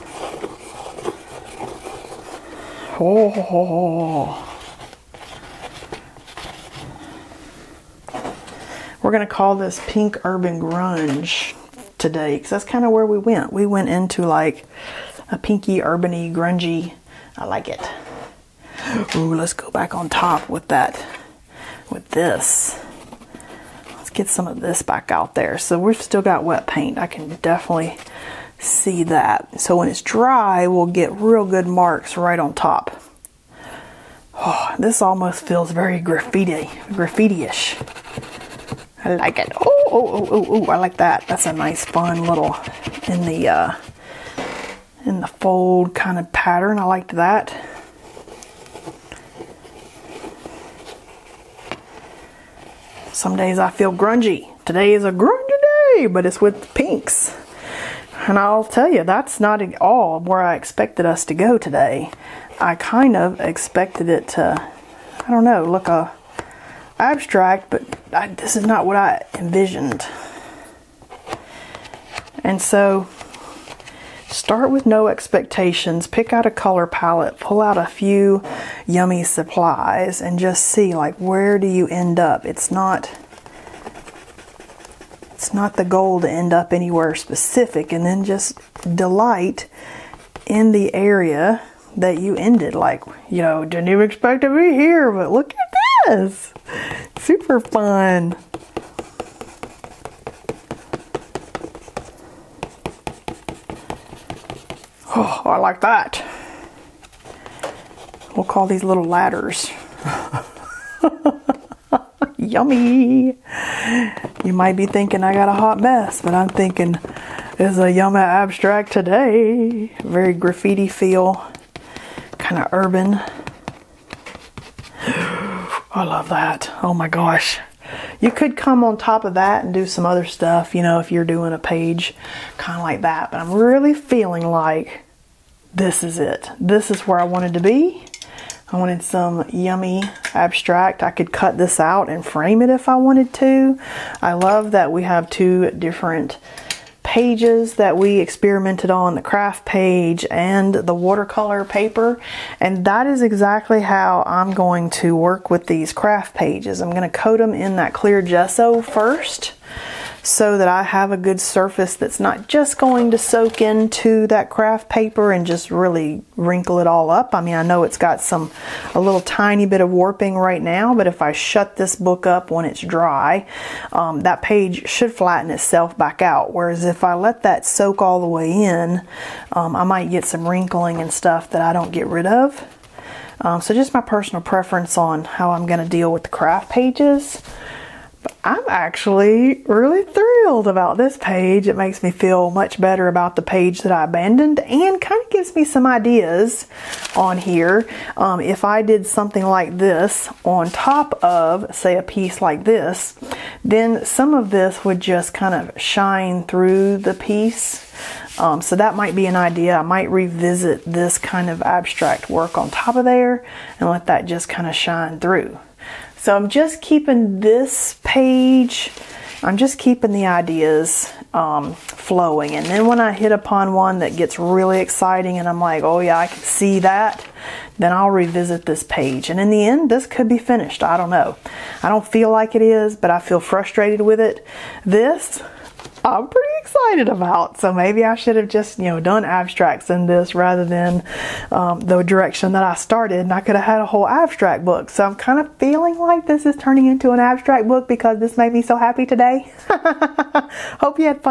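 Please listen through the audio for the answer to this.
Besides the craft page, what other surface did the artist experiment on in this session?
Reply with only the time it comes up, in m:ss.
2:30.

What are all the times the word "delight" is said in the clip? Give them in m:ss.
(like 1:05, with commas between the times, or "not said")
1:28.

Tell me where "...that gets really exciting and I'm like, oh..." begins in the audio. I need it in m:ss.
3:43.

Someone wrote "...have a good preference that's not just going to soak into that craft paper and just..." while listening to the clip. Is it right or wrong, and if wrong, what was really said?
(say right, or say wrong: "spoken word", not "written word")
wrong: "surface", not "preference".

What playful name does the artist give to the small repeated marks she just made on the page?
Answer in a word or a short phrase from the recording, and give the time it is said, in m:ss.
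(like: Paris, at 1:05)
little ladders, at 1:48.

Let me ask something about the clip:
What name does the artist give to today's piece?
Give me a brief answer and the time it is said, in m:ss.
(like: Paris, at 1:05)
Pink Urban Grunge, at 0:09.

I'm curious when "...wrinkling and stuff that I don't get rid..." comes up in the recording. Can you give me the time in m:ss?
3:00.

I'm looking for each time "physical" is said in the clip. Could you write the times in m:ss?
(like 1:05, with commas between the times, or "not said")
not said.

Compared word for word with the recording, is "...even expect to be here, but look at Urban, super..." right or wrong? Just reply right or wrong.
wrong.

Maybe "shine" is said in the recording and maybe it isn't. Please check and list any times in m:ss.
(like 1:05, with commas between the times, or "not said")
3:25, 3:34.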